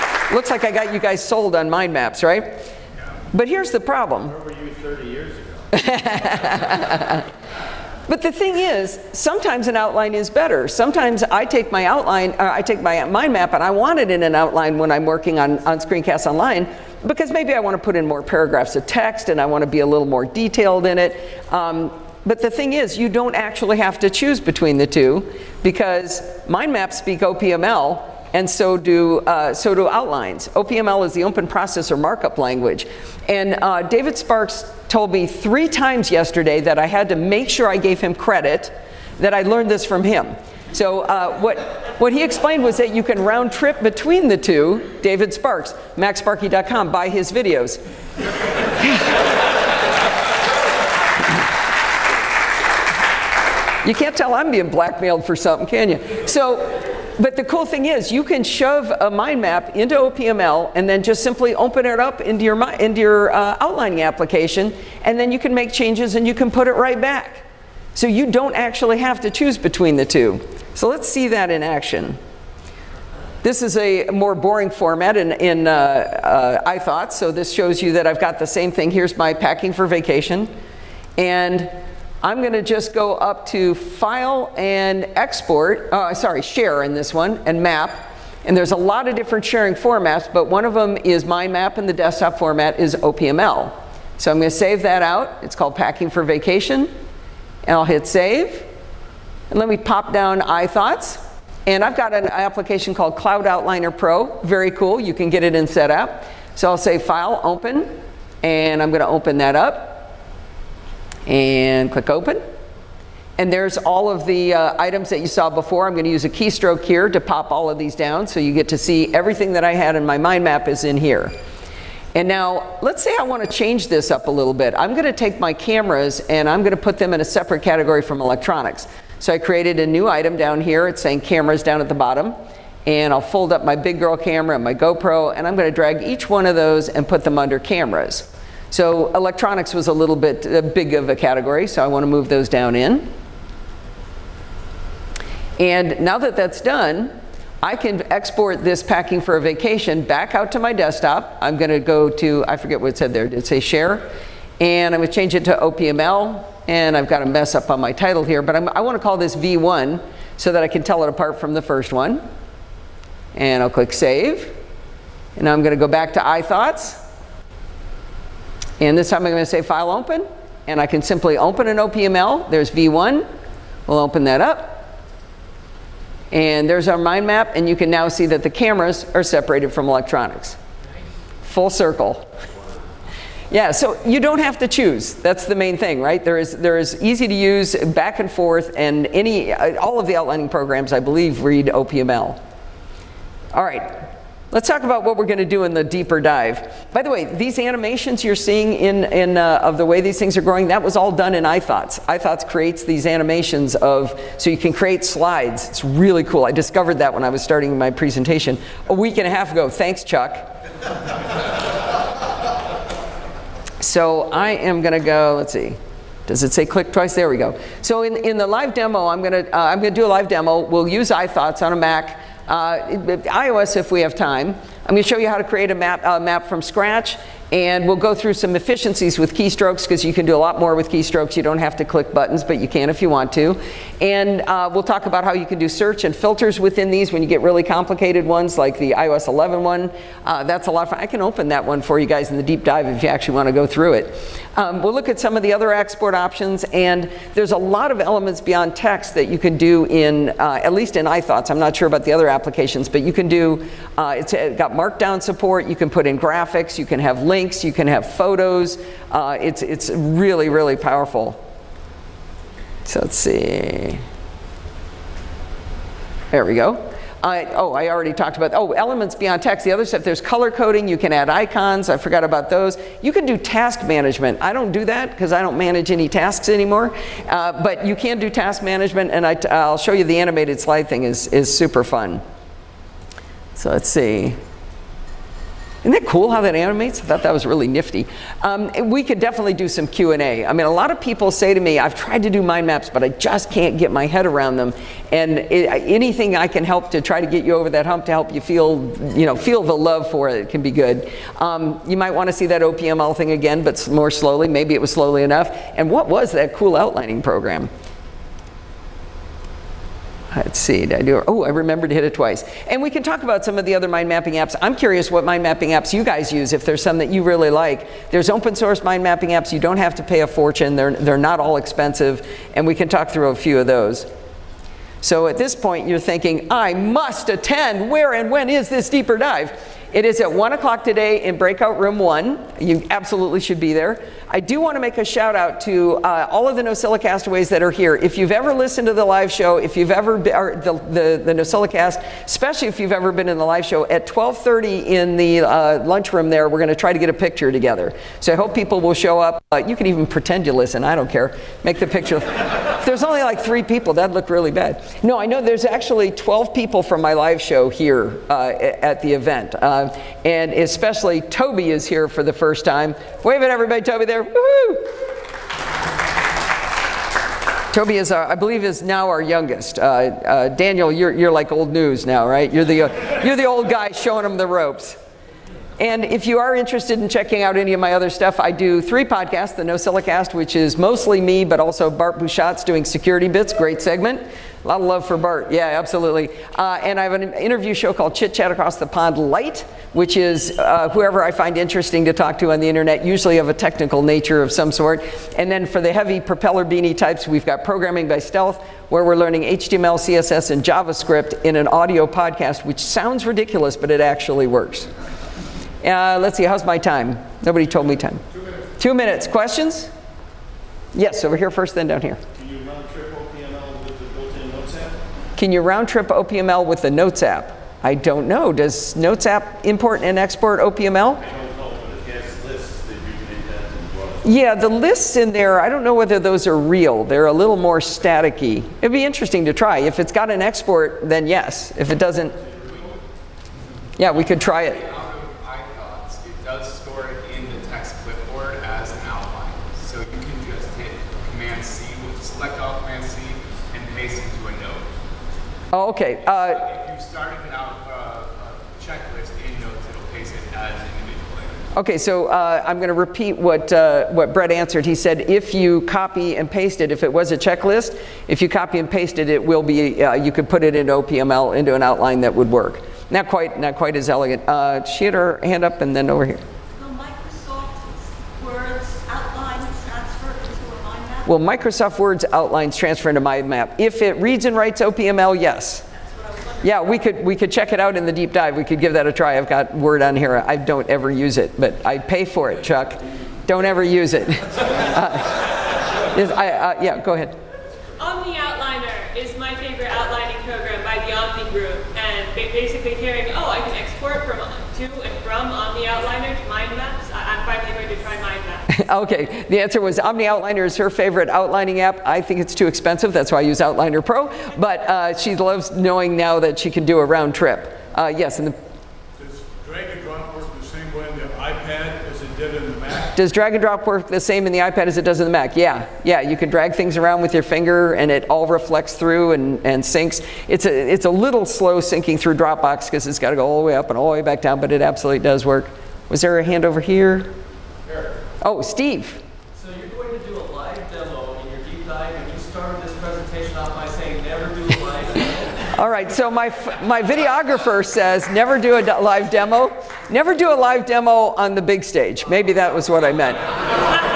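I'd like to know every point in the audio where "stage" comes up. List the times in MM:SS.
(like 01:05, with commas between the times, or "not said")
09:01.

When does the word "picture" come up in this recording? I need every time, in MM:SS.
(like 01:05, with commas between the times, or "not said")
05:47, 05:51.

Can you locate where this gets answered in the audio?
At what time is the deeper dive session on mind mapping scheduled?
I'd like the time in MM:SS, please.
05:30.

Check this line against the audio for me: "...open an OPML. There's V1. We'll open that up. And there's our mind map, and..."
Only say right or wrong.
right.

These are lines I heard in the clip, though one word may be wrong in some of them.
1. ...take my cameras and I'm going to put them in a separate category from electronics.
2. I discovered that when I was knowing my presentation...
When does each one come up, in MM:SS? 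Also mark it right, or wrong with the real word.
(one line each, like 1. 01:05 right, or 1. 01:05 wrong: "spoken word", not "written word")
1. 02:05 right
2. 03:26 wrong: "starting", not "knowing".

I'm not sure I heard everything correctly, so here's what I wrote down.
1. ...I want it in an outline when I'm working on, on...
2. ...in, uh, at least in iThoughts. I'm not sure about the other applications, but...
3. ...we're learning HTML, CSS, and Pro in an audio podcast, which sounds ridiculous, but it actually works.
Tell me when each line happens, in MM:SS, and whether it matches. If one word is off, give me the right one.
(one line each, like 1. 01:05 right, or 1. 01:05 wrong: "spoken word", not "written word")
1. 00:13 right
2. 04:09 right
3. 06:39 wrong: "JavaScript", not "Pro".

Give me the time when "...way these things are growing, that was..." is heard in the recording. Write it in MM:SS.
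03:19.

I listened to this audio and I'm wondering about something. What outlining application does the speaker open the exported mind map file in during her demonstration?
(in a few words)
Cloud Outliner Pro.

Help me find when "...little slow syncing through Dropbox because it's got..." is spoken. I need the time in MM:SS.
08:41.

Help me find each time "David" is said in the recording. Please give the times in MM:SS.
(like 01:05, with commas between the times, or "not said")
00:33, 00:45.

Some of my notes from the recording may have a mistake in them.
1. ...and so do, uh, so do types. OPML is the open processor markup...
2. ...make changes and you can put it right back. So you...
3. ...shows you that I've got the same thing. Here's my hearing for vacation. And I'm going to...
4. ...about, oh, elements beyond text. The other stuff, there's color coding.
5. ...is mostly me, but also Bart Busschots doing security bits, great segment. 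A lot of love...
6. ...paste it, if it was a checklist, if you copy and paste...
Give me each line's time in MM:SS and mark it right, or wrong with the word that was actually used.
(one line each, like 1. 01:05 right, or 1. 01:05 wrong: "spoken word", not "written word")
1. 00:28 wrong: "outlines", not "types"
2. 01:05 right
3. 01:17 wrong: "packing", not "hearing"
4. 04:28 right
5. 06:20 right
6. 07:36 right.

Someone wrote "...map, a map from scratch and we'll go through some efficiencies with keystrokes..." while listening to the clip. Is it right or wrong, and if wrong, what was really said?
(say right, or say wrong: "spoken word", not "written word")
right.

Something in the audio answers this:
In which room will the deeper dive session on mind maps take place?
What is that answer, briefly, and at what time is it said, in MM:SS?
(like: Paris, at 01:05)
breakout room 1, at 05:31.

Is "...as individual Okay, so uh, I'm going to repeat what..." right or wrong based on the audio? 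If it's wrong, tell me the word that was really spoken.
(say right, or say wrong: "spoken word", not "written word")
right.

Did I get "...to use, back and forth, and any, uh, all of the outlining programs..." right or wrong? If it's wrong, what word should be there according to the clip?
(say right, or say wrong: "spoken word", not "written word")
right.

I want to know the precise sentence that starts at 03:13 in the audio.
All right, Let's talk about what we're going to do in the deeper dive.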